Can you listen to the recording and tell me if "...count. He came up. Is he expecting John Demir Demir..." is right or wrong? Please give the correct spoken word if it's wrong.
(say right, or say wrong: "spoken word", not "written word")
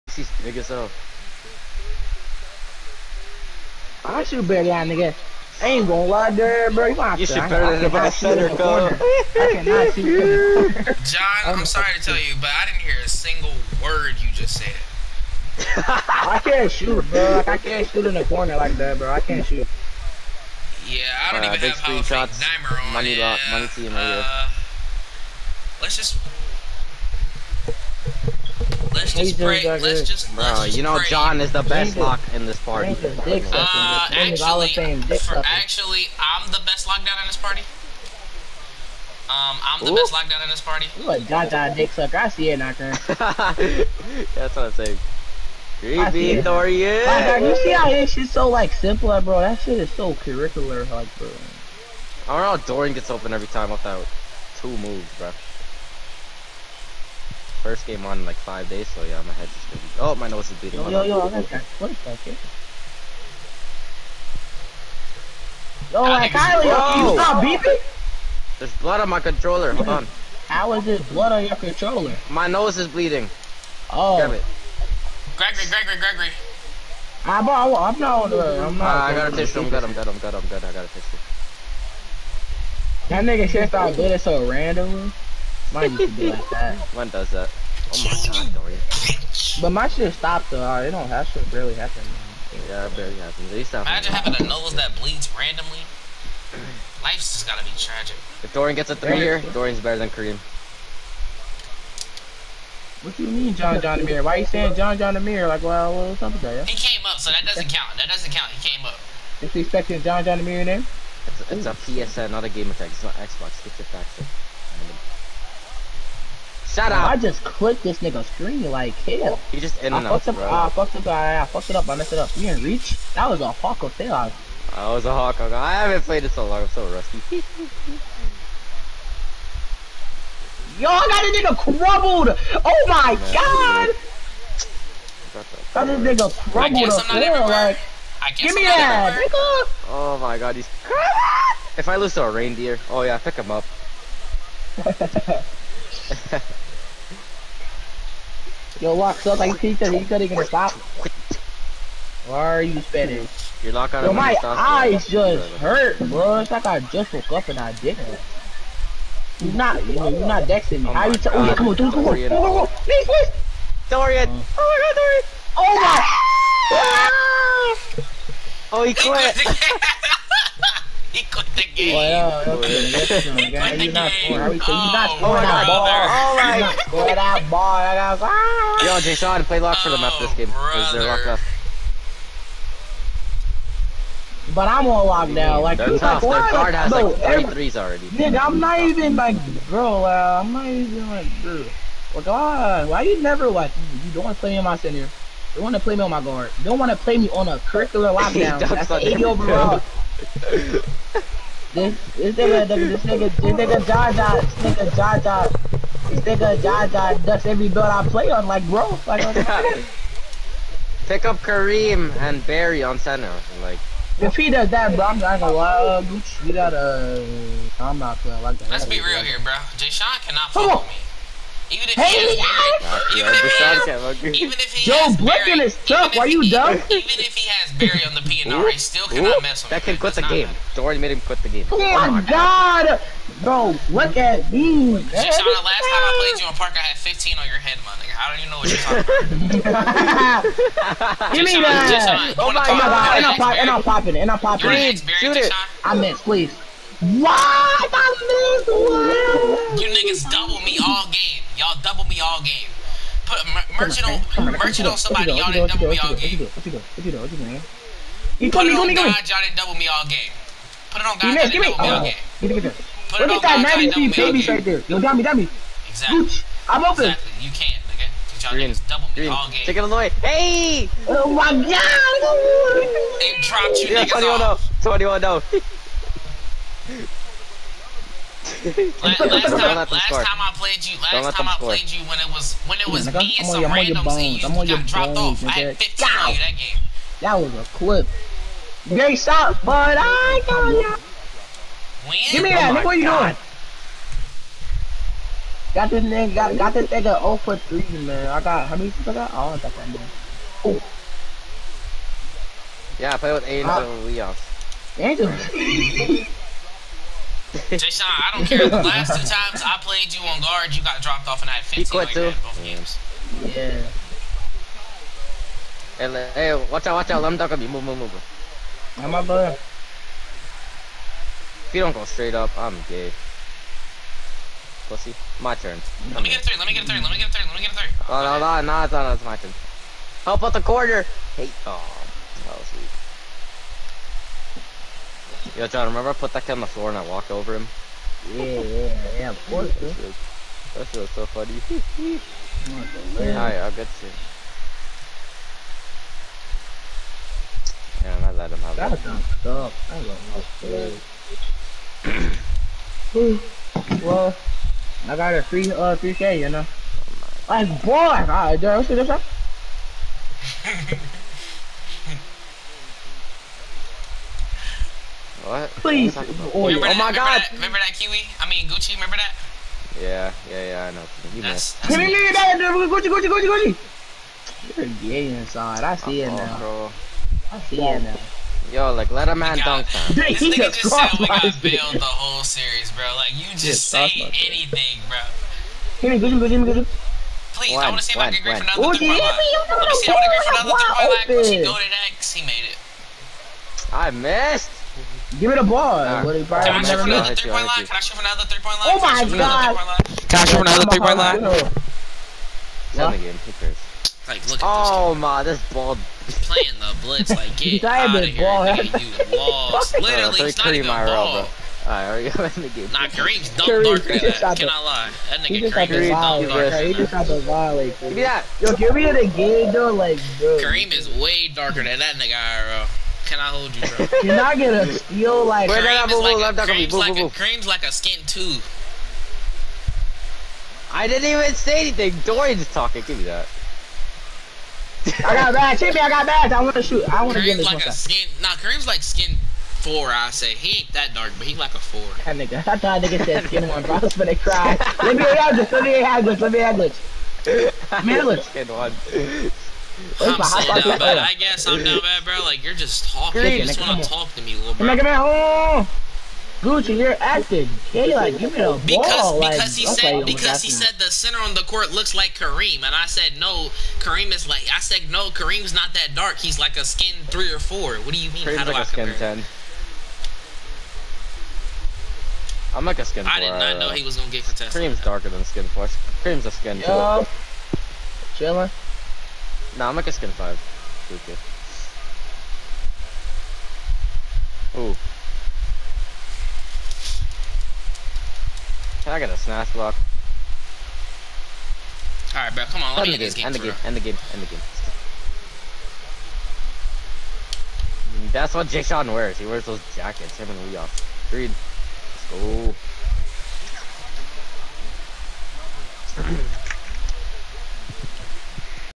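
wrong: "John", not "Demir".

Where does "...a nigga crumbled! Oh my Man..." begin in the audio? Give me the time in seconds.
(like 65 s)
131 s.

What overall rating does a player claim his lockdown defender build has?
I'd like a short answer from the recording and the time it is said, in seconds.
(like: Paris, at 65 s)
80 overall, at 198 s.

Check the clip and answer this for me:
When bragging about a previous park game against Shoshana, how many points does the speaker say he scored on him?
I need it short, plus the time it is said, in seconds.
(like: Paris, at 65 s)
15, at 236 s.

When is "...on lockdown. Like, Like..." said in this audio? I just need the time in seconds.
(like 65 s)
184 s.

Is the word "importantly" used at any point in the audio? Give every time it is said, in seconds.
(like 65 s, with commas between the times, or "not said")
not said.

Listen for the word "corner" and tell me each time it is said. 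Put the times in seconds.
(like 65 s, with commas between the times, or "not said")
8 s, 18 s, 330 s.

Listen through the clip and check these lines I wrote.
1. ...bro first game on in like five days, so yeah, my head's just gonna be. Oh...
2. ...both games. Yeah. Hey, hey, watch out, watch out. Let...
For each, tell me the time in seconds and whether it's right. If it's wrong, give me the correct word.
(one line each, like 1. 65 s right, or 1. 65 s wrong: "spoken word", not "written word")
1. 55 s right
2. 312 s right.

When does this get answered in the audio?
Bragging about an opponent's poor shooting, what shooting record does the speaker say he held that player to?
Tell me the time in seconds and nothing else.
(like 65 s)
297 s.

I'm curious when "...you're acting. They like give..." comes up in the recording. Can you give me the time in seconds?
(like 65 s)
456 s.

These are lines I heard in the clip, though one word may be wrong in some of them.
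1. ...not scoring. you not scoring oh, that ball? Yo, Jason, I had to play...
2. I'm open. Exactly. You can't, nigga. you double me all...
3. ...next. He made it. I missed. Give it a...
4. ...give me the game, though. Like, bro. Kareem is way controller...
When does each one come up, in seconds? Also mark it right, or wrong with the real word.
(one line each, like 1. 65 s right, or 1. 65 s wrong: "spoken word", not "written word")
1. 173 s right
2. 266 s right
3. 392 s right
4. 418 s wrong: "darker", not "controller".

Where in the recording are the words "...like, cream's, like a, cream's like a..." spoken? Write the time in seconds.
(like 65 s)
426 s.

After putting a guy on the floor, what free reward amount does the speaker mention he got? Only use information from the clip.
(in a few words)
3K.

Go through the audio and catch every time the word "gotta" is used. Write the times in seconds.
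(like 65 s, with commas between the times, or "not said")
97 s, 216 s.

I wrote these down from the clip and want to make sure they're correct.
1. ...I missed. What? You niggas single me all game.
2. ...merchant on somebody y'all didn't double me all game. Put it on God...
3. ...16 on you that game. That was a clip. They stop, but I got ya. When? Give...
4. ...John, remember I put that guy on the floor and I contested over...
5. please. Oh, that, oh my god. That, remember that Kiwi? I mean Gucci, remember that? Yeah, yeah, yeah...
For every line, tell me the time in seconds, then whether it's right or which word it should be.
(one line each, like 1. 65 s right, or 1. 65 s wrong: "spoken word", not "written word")
1. 247 s wrong: "double", not "single"
2. 254 s right
3. 285 s wrong: "15", not "16"
4. 335 s wrong: "walked", not "contested"
5. 365 s right.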